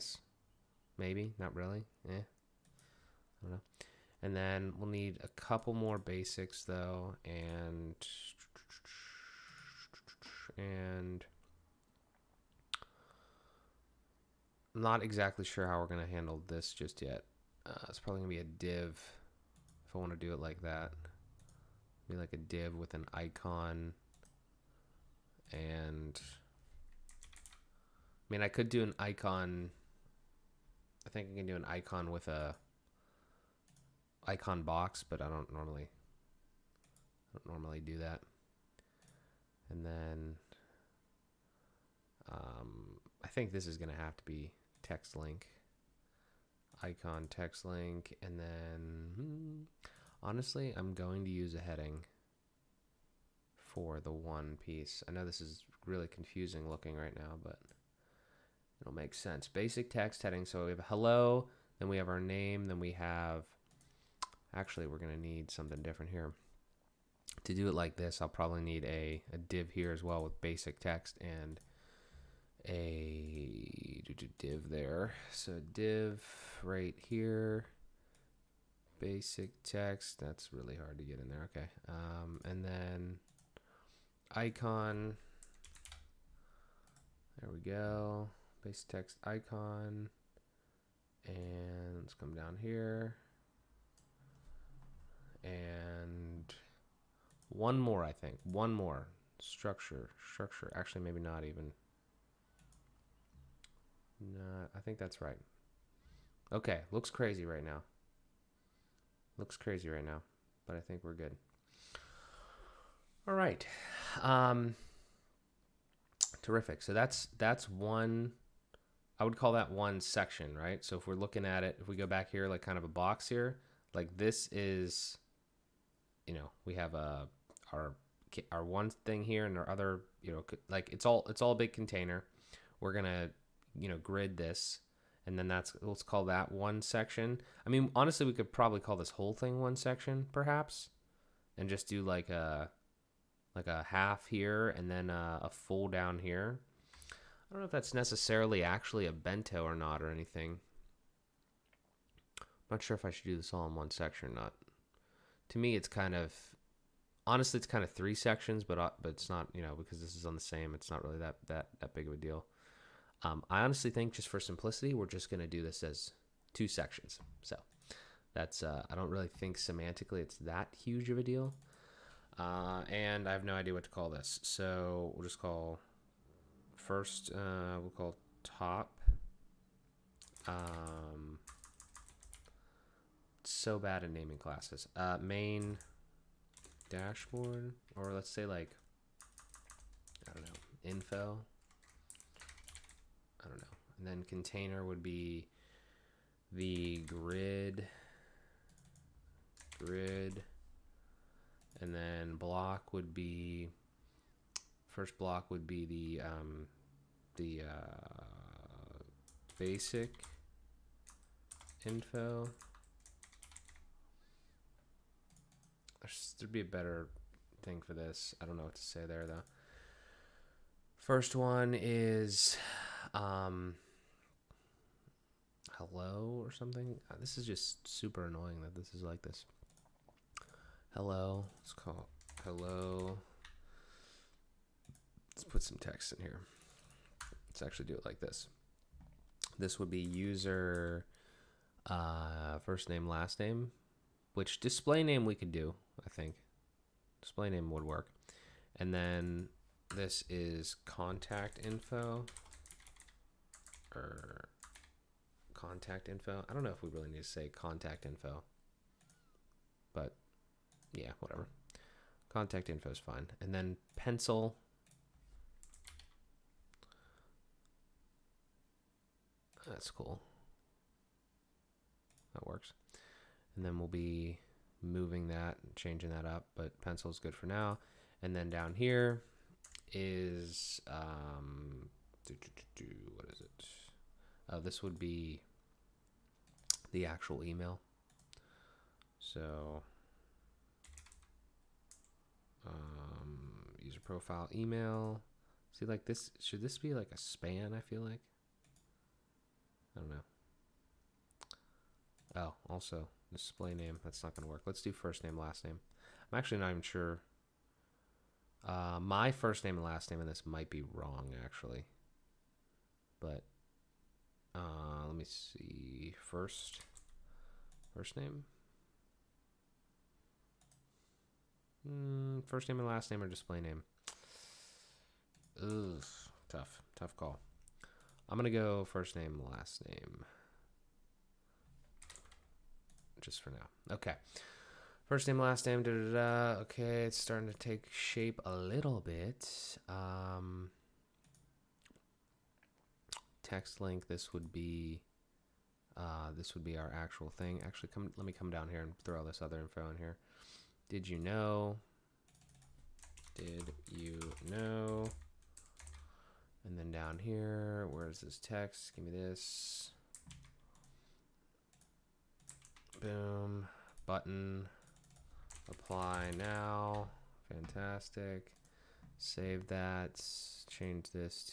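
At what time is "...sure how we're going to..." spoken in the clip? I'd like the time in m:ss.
0:15.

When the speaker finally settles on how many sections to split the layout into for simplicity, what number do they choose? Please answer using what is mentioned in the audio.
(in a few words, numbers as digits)
2.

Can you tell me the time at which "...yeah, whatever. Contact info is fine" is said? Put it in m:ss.
4:20.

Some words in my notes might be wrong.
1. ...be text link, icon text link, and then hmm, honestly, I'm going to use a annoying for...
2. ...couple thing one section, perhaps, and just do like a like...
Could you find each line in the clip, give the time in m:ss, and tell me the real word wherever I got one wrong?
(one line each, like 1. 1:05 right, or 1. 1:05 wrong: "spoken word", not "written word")
1. 0:44 wrong: "heading", not "annoying"
2. 2:19 wrong: "whole", not "couple".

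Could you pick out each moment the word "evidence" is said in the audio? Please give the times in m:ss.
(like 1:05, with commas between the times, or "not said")
not said.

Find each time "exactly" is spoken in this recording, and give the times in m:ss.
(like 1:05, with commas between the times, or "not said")
0:15.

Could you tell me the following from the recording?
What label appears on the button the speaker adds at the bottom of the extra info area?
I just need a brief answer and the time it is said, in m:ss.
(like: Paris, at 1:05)
Apply now, at 6:05.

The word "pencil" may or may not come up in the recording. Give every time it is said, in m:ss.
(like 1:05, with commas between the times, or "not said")
4:23, 4:36.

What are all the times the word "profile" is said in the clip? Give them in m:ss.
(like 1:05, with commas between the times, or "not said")
4:54.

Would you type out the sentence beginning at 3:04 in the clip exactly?
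Uh, main dashboard, or let's say like, I don't know, info.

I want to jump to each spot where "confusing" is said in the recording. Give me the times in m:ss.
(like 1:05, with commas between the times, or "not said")
0:56.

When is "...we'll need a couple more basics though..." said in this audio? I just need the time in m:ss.
0:04.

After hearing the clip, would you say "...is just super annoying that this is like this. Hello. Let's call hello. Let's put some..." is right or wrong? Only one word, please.
right.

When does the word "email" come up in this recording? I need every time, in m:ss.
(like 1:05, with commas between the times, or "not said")
4:47, 4:54.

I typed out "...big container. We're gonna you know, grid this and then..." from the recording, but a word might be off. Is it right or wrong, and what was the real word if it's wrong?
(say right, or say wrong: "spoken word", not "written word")
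right.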